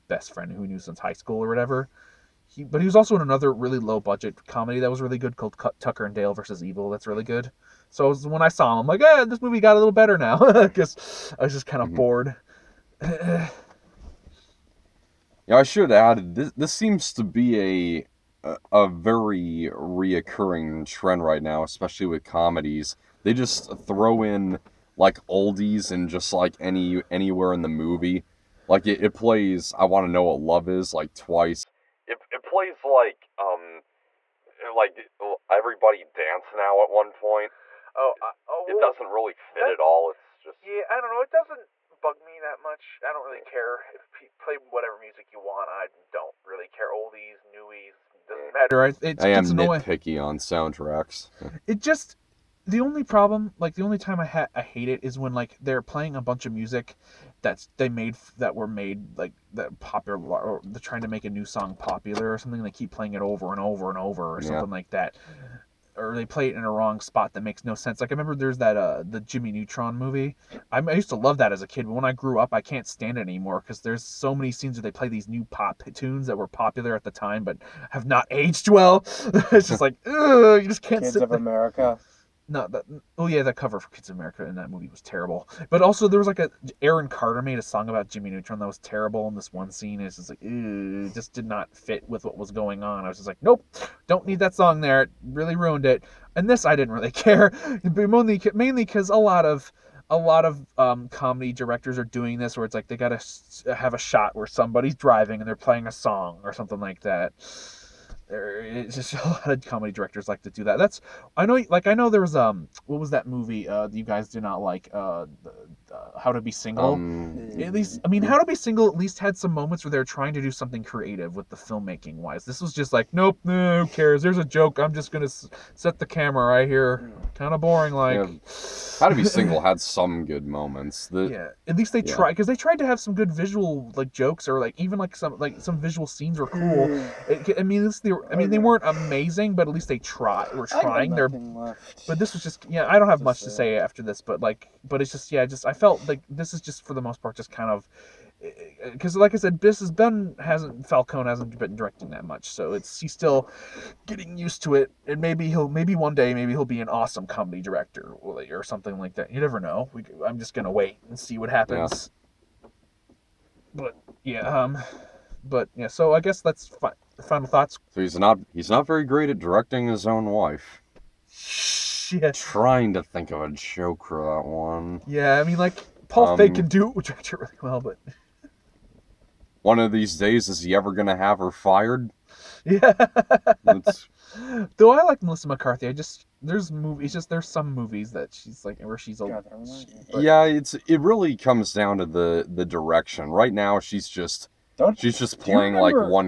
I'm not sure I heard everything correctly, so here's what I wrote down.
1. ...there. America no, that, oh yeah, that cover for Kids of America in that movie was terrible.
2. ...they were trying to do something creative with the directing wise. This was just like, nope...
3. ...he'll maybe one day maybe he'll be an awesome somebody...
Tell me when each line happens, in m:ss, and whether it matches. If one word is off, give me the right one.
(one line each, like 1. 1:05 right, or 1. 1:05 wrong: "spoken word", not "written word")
1. 1:21 right
2. 1:59 wrong: "filmmaking", not "directing"
3. 2:35 wrong: "comedy", not "somebody".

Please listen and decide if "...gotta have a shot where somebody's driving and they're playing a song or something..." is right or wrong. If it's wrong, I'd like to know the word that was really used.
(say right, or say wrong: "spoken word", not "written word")
right.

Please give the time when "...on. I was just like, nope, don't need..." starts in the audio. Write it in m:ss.
1:32.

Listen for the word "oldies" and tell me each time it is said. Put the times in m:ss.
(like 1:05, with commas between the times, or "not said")
0:25, 0:46.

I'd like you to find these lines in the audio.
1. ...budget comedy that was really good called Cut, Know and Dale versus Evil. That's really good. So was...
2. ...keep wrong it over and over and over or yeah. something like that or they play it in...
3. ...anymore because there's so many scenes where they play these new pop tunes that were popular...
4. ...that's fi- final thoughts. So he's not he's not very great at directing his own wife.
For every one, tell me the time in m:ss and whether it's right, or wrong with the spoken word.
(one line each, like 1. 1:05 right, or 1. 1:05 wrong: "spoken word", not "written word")
1. 0:03 wrong: "Tucker", not "Know"
2. 1:02 wrong: "playing", not "wrong"
3. 1:13 right
4. 2:46 right.